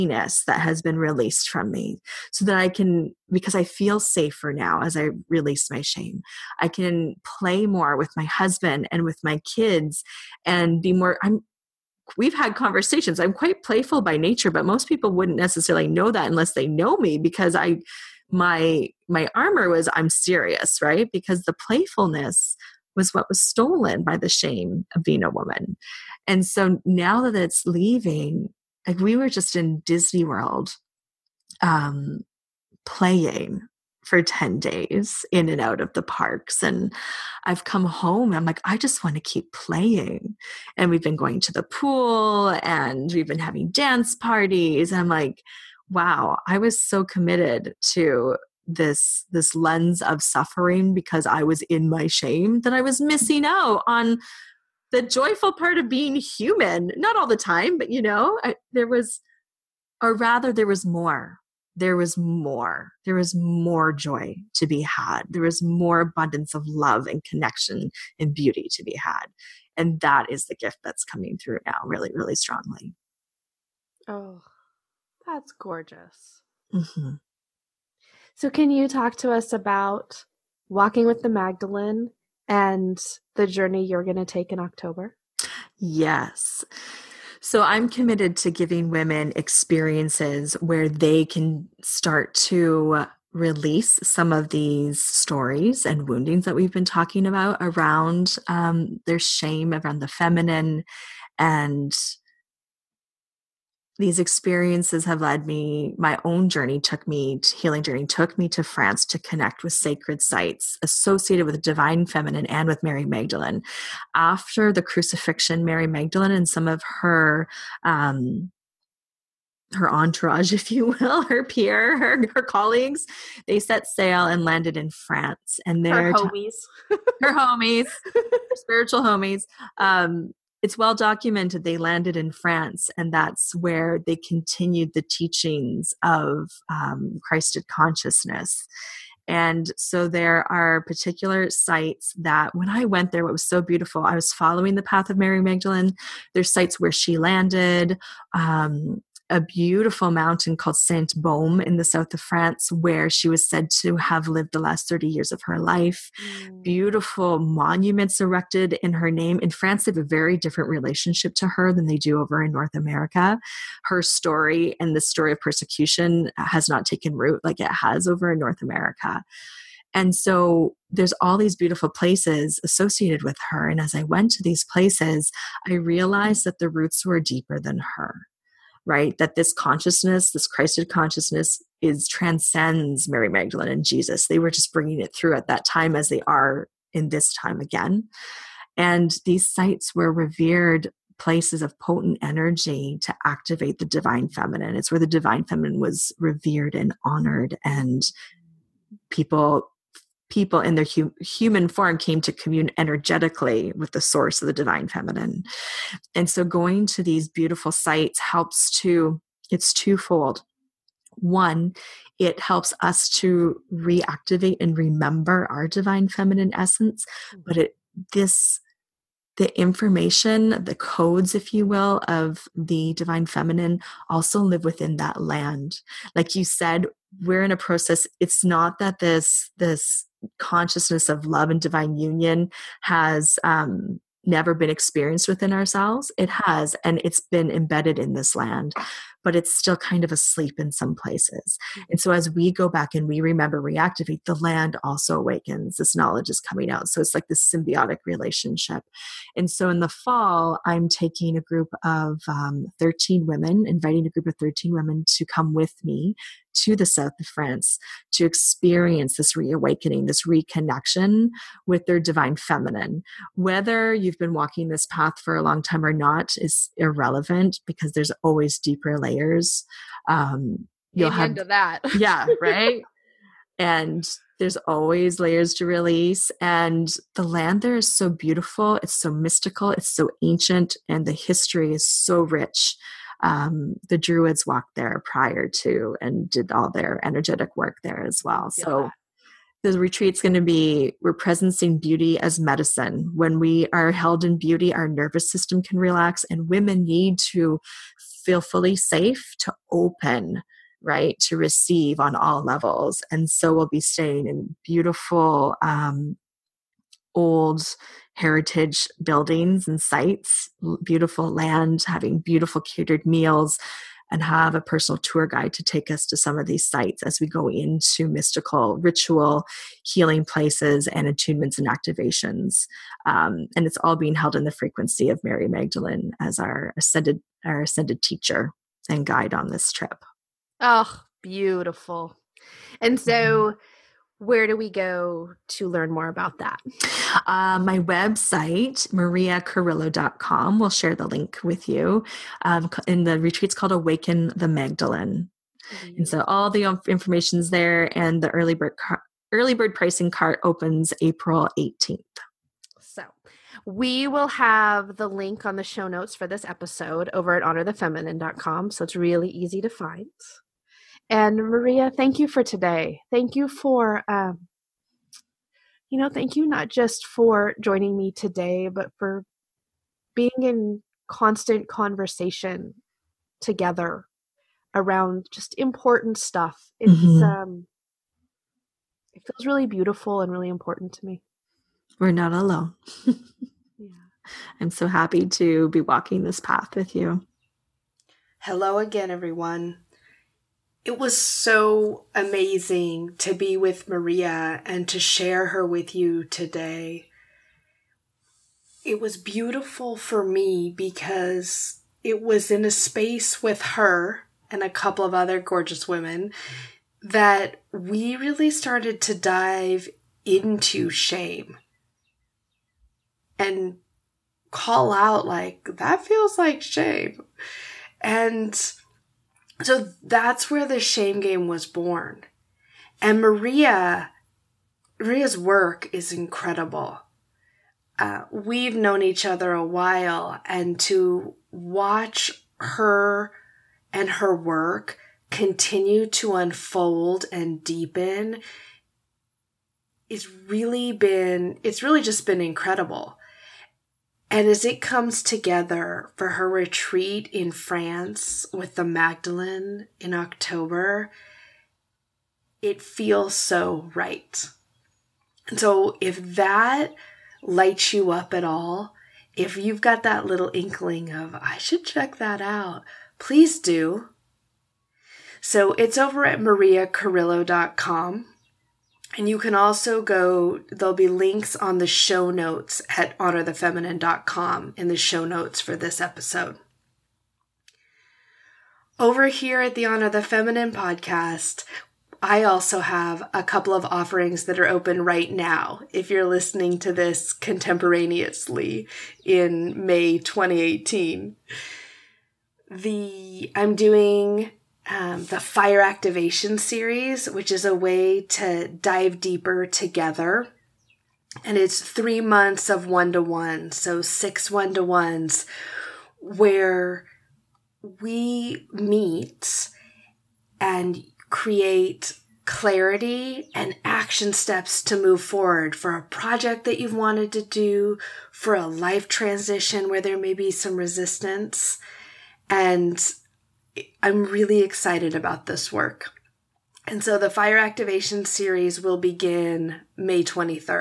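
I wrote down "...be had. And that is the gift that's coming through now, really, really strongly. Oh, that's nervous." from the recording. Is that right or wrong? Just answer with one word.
wrong.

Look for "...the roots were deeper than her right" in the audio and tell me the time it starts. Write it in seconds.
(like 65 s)
176 s.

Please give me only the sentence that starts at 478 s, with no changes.
Over here at the Honor the Feminine podcast, I also have a couple of offerings that are open right now.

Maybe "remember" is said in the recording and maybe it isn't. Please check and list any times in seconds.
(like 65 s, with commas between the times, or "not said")
214 s, 243 s.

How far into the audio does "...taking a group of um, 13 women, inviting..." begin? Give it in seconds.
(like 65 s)
250 s.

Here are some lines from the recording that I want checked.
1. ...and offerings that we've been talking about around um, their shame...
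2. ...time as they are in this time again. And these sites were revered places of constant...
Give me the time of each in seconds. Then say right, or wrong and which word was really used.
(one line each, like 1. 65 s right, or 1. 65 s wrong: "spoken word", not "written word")
1. 95 s wrong: "woundings", not "offerings"
2. 185 s wrong: "potent", not "constant".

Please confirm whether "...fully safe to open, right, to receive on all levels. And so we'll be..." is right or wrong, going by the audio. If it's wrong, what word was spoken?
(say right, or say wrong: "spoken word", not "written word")
right.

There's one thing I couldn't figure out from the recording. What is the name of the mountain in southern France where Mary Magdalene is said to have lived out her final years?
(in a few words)
Saint Baume.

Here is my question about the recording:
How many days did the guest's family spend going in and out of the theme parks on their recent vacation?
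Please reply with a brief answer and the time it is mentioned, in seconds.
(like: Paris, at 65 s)
10, at 34 s.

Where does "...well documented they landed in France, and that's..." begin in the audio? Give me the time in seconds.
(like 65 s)
130 s.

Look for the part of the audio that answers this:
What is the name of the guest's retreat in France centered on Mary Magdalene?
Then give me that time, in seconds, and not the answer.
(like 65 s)
343 s.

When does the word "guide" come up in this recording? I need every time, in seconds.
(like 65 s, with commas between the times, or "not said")
315 s, 329 s.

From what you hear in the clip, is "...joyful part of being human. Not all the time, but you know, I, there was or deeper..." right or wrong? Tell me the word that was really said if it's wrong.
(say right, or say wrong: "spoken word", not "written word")
wrong: "rather", not "deeper".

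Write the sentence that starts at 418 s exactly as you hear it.
And so that's where the shame game was born.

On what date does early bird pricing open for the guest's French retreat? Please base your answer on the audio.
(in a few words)
April 18.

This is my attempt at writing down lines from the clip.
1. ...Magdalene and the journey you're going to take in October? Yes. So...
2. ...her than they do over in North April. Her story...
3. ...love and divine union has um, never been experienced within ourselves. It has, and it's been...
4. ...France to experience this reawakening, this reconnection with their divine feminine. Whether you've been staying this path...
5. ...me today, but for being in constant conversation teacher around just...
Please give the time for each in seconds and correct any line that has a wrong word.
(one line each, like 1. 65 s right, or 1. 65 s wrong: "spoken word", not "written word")
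1. 81 s right
2. 161 s wrong: "America", not "April"
3. 231 s right
4. 257 s wrong: "walking", not "staying"
5. 367 s wrong: "together", not "teacher".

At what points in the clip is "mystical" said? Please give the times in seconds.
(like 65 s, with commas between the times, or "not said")
279 s, 318 s.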